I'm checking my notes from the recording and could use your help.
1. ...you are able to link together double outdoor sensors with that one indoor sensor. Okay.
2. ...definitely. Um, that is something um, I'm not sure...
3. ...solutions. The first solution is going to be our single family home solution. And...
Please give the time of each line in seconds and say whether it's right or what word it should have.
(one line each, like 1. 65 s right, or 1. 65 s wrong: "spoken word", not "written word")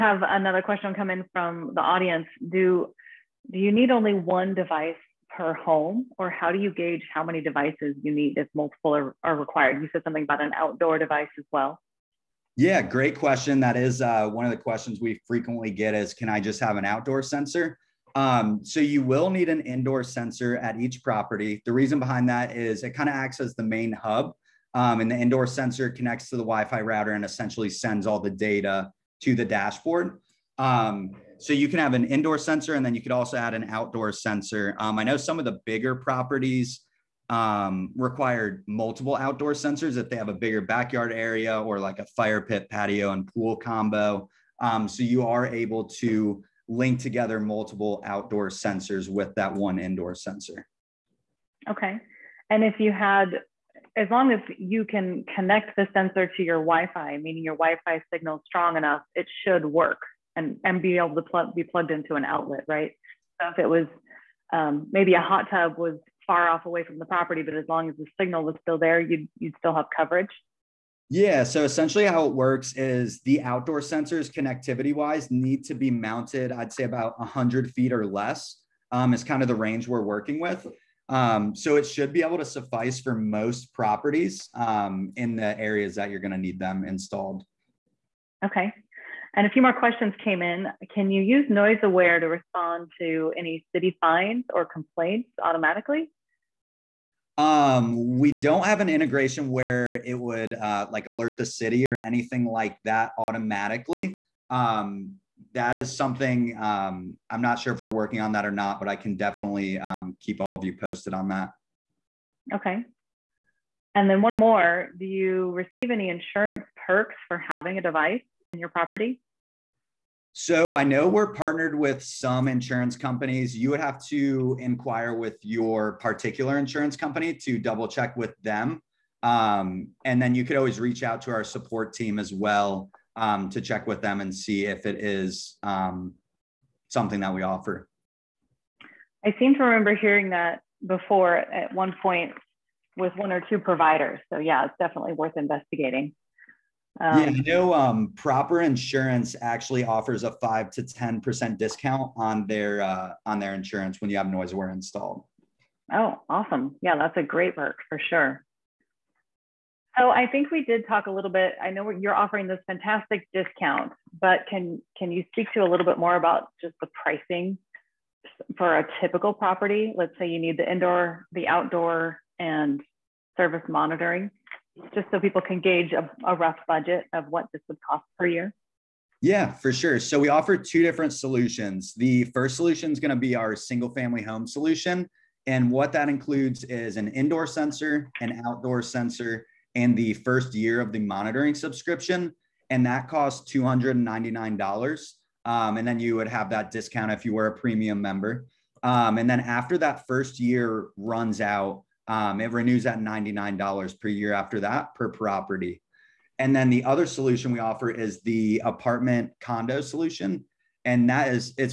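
1. 45 s wrong: "multiple", not "double"
2. 103 s wrong: "automatically", not "definitely"
3. 181 s right.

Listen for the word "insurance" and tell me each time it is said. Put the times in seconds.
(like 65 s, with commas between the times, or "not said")
116 s, 122 s, 126 s, 148 s, 153 s.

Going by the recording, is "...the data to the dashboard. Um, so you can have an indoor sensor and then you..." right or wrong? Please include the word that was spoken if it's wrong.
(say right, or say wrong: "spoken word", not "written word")
right.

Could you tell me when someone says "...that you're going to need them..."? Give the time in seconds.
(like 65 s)
85 s.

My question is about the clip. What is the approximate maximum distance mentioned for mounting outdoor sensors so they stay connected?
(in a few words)
100 feet.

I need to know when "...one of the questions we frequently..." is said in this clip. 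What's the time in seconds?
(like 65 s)
14 s.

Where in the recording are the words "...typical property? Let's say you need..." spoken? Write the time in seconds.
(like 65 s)
169 s.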